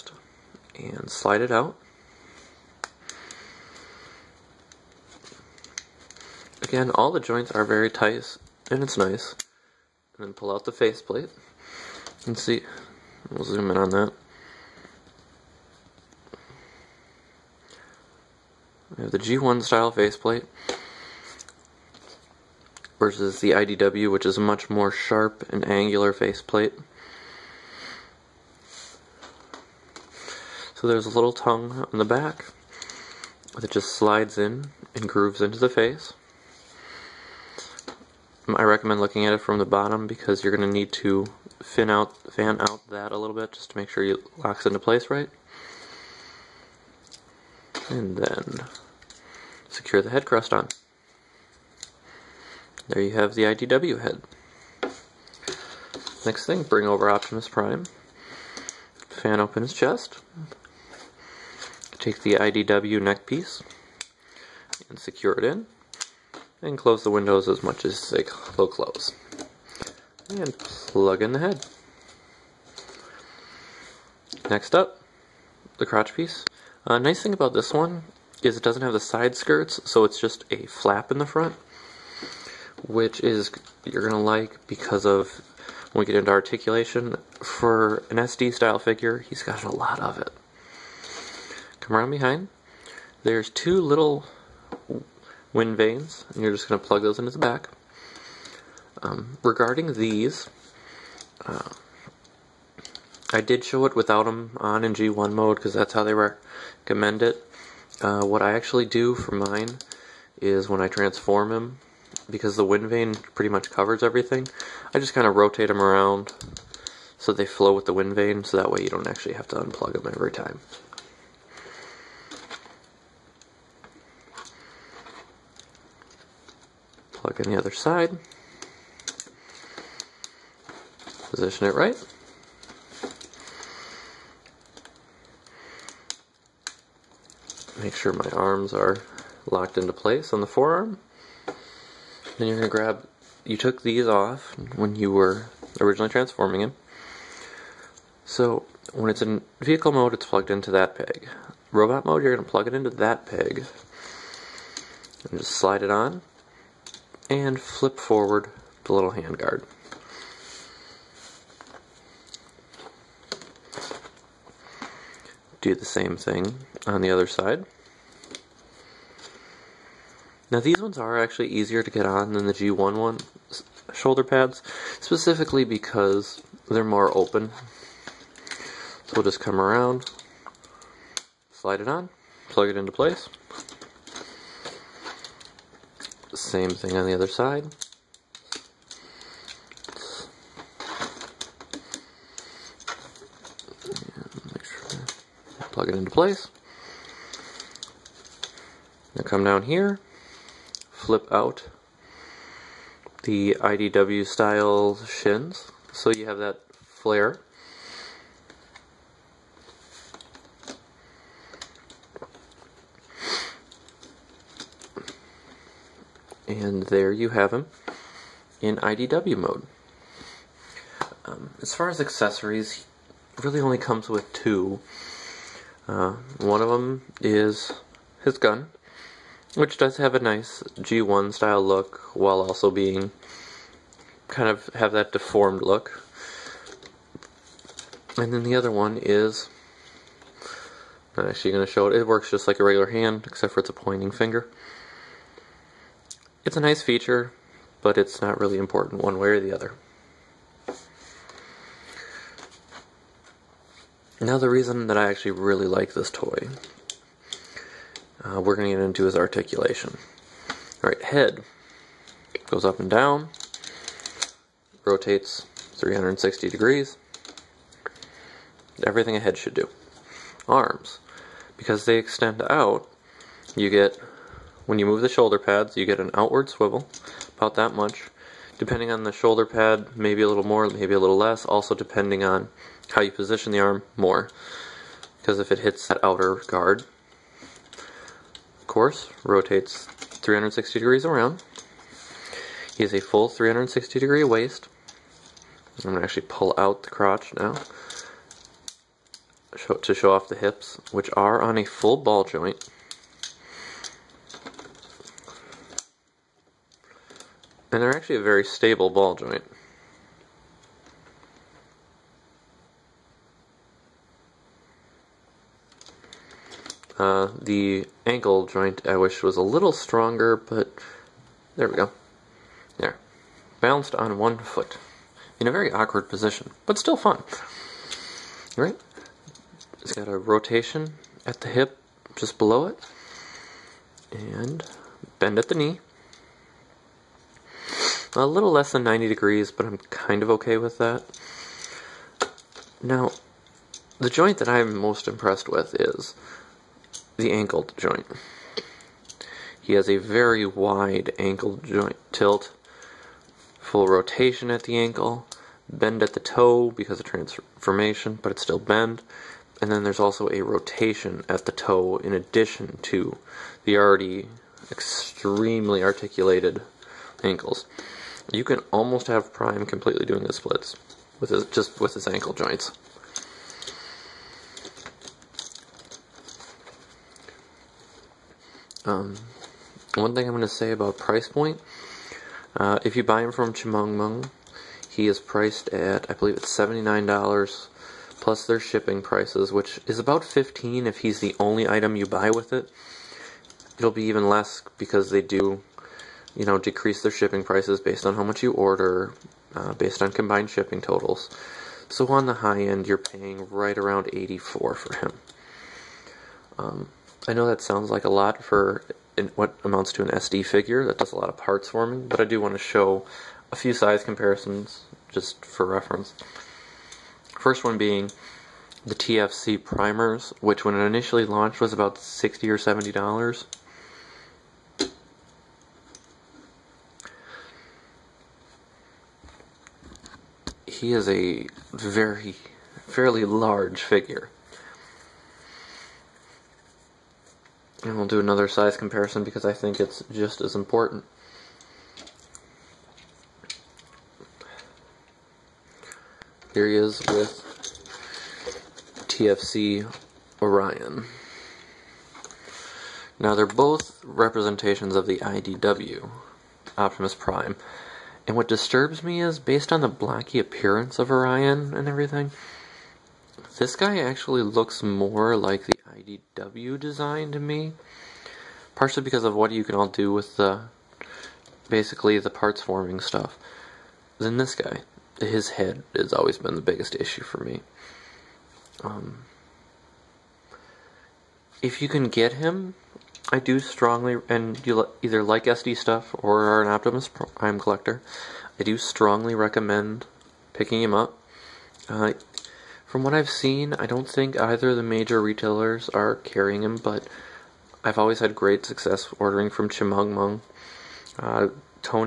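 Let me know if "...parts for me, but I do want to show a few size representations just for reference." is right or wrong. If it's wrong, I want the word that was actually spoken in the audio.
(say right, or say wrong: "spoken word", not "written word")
wrong: "comparisons", not "representations".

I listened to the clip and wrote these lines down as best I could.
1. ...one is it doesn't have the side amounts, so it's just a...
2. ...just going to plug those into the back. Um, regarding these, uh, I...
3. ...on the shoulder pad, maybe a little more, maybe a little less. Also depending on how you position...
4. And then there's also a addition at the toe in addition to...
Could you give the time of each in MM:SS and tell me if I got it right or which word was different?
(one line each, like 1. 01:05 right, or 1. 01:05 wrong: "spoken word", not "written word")
1. 01:17 wrong: "skirts", not "amounts"
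2. 01:36 right
3. 04:38 right
4. 05:59 wrong: "rotation", not "addition".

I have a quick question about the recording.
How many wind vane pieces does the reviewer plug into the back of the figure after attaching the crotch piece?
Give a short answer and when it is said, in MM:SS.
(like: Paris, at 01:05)
2, at 01:33.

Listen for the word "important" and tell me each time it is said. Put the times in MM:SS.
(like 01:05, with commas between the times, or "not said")
04:08, 07:20.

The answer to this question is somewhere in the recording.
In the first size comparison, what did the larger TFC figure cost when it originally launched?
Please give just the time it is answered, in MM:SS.
07:01.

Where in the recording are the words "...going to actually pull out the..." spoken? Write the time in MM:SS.
04:55.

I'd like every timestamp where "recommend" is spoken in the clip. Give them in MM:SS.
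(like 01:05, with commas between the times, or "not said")
00:38, 01:46, 08:09.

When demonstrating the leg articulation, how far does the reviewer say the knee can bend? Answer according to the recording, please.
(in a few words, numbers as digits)
A little less than 90 degrees.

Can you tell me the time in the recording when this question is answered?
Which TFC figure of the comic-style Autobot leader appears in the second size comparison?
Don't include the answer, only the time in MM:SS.
07:29.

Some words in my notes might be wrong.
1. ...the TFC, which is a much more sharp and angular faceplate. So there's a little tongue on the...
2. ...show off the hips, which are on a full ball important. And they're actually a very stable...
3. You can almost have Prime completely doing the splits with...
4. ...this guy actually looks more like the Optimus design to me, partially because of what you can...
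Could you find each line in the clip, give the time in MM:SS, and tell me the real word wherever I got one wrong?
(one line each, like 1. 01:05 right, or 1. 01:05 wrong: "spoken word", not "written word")
1. 00:23 wrong: "IDW", not "TFC"
2. 04:59 wrong: "joint", not "important"
3. 06:08 right
4. 07:43 wrong: "IDW", not "Optimus".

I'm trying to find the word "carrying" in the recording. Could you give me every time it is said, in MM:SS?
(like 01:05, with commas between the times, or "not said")
08:16.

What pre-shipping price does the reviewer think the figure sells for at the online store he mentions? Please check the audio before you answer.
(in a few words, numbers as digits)
$79.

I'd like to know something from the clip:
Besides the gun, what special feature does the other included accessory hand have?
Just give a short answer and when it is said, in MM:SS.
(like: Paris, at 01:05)
A pointing finger, at 04:03.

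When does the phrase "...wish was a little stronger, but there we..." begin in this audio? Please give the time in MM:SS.
05:18.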